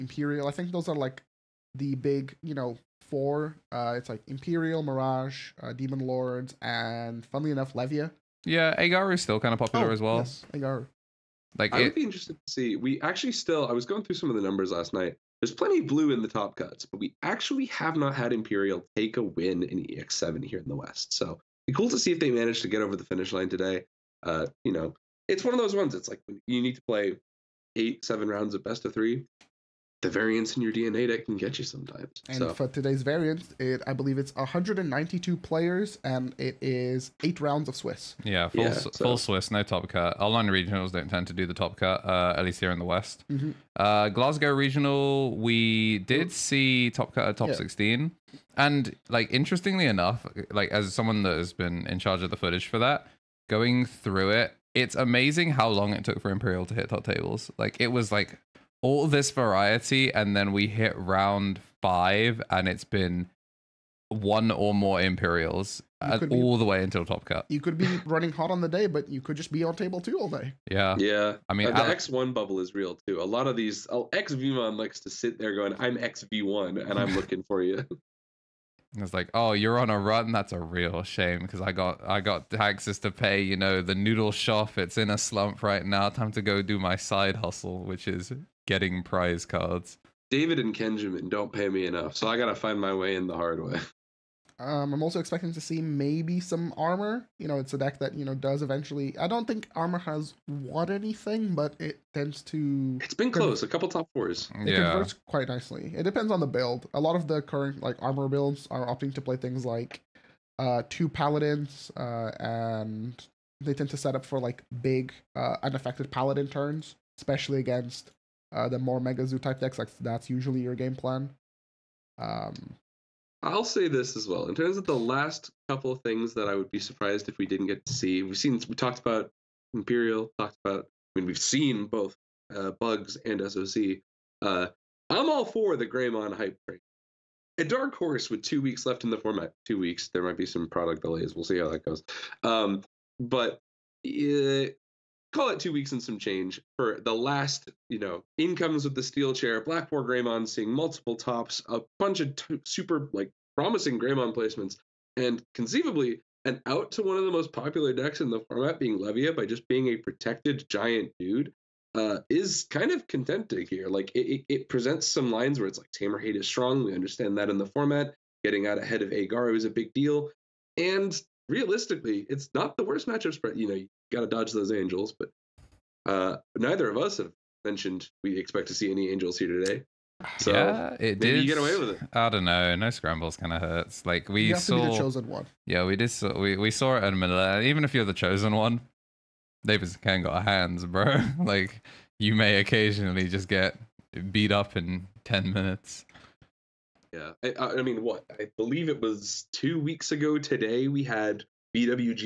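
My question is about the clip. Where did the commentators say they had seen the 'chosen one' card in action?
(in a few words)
Manila.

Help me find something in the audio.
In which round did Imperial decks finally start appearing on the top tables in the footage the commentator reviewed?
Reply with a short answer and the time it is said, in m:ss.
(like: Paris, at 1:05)
Round five, at 1:00.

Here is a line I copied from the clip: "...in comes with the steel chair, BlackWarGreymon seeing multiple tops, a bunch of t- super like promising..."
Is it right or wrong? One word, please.
right.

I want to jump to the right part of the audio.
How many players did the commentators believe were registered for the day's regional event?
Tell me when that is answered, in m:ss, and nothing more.
0:34.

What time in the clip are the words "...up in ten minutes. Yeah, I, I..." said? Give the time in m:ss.
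3:14.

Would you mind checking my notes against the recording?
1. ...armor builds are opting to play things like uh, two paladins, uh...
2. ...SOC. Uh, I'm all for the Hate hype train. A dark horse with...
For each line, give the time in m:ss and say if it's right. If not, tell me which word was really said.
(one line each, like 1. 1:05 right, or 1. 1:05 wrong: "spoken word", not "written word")
1. 1:47 right
2. 2:13 wrong: "Greymon", not "Hate".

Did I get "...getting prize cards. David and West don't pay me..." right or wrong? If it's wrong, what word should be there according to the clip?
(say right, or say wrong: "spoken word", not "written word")
wrong: "Kenjamin", not "West".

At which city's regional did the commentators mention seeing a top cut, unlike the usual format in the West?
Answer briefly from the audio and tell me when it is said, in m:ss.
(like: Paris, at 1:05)
Glasgow, at 0:44.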